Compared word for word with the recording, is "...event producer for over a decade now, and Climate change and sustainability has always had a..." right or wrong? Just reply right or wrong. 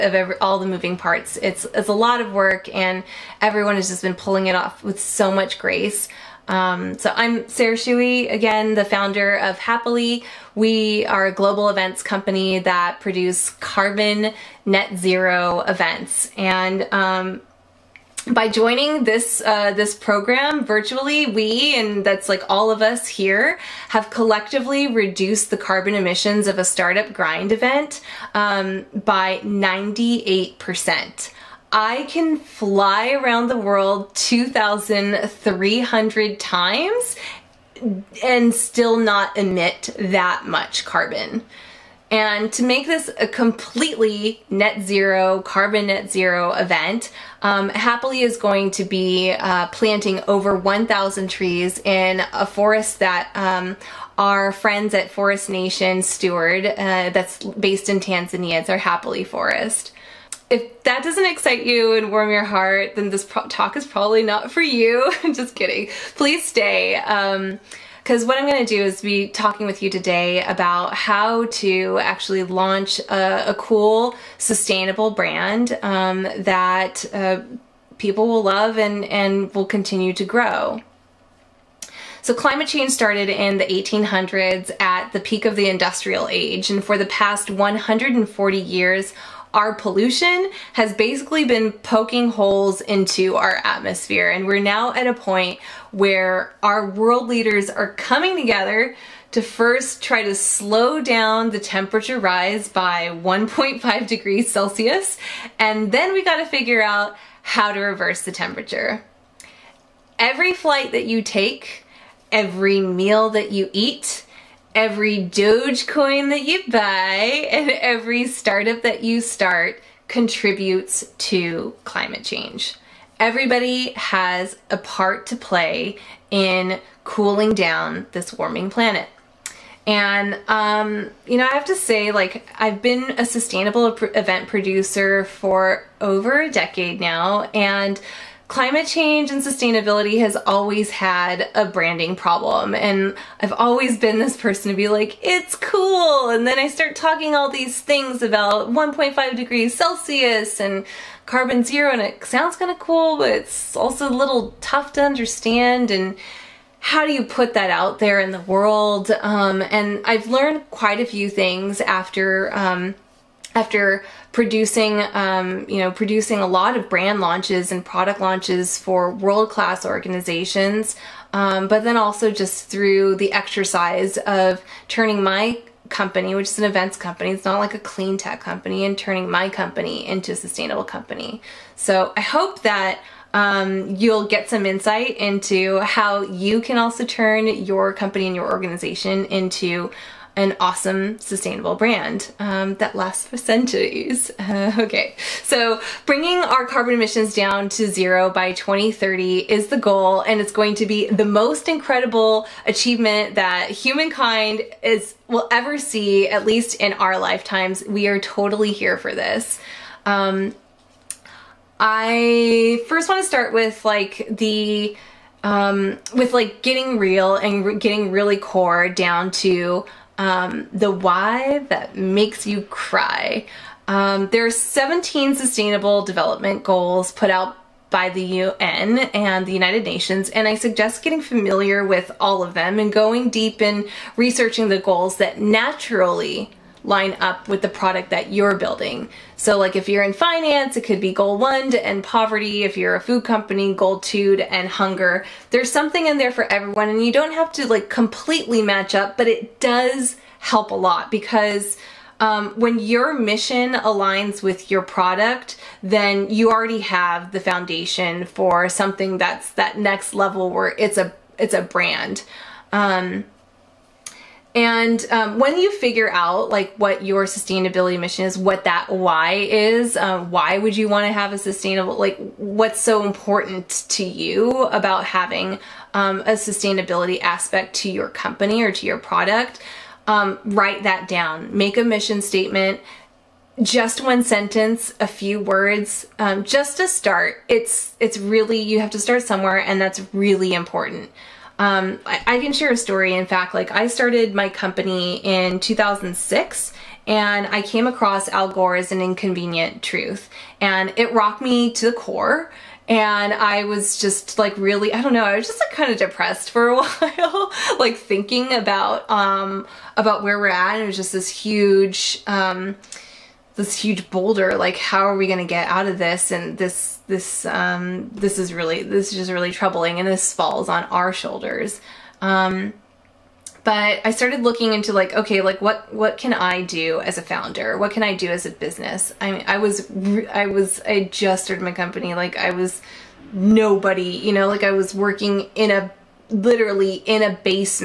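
right.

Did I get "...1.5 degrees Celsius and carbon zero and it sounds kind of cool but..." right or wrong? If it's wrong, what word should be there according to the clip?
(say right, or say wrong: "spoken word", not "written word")
right.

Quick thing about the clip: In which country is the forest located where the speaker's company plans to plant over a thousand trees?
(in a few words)
Tanzania.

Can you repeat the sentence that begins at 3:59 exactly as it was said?
So like if you're in finance, it could be goal one to end poverty.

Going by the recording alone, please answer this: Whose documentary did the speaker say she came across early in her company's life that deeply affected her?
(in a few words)
Al Gore.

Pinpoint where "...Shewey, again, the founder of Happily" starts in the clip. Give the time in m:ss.
0:07.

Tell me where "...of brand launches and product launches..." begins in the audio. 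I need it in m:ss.
2:46.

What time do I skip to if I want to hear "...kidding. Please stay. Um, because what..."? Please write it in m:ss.
1:05.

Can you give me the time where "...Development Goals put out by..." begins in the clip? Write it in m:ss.
3:46.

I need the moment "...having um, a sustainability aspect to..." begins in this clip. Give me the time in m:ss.
4:35.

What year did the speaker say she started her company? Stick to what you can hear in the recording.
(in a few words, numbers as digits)
2006.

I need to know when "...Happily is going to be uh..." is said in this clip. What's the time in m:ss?
0:47.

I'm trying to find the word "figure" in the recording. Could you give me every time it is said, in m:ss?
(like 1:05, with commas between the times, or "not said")
1:46, 4:25.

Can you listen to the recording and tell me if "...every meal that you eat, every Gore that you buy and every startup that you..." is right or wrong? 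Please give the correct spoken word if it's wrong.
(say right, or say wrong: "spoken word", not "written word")
wrong: "Dogecoin", not "Gore".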